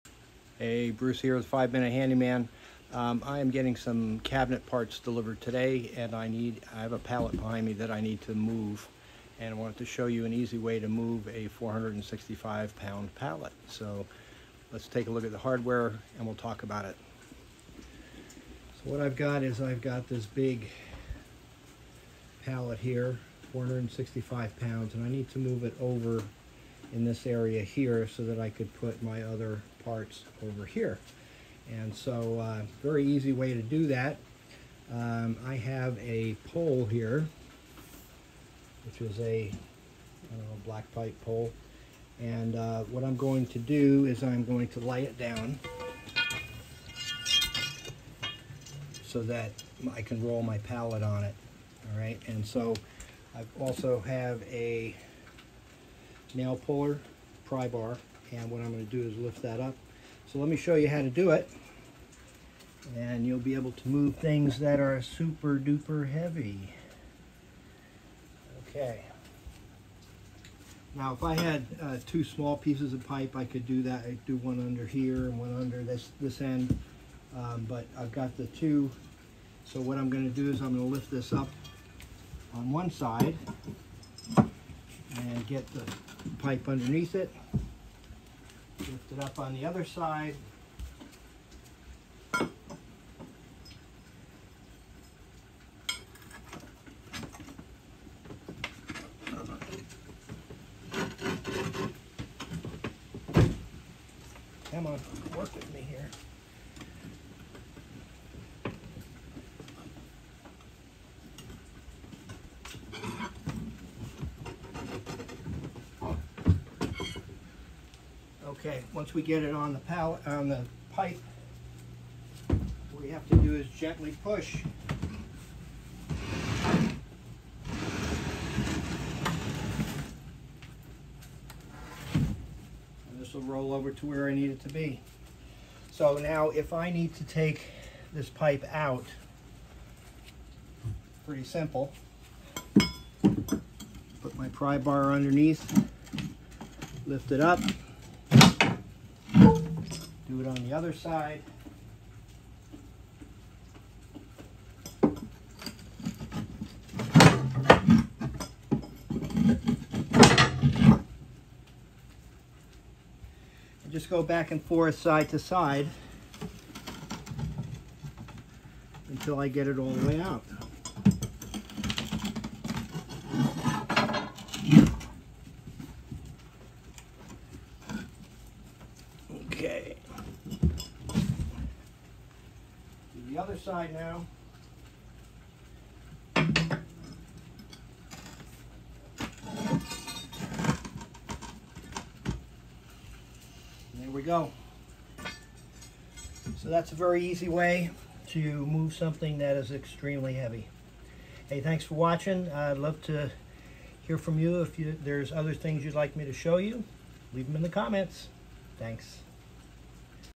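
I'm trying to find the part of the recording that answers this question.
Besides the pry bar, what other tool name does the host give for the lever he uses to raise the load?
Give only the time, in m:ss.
0:56.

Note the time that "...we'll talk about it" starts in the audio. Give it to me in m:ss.
0:16.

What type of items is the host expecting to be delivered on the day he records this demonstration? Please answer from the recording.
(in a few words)
cabinet parts.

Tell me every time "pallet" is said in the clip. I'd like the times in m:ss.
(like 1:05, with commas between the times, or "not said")
0:06, 0:13, 0:22, 0:50, 1:59.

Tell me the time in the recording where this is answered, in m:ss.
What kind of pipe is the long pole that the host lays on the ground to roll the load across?
0:40.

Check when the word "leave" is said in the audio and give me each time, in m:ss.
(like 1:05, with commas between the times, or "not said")
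3:27.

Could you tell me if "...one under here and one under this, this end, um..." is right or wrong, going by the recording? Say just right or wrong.
right.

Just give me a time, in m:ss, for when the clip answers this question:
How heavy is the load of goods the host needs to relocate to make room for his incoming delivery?
0:11.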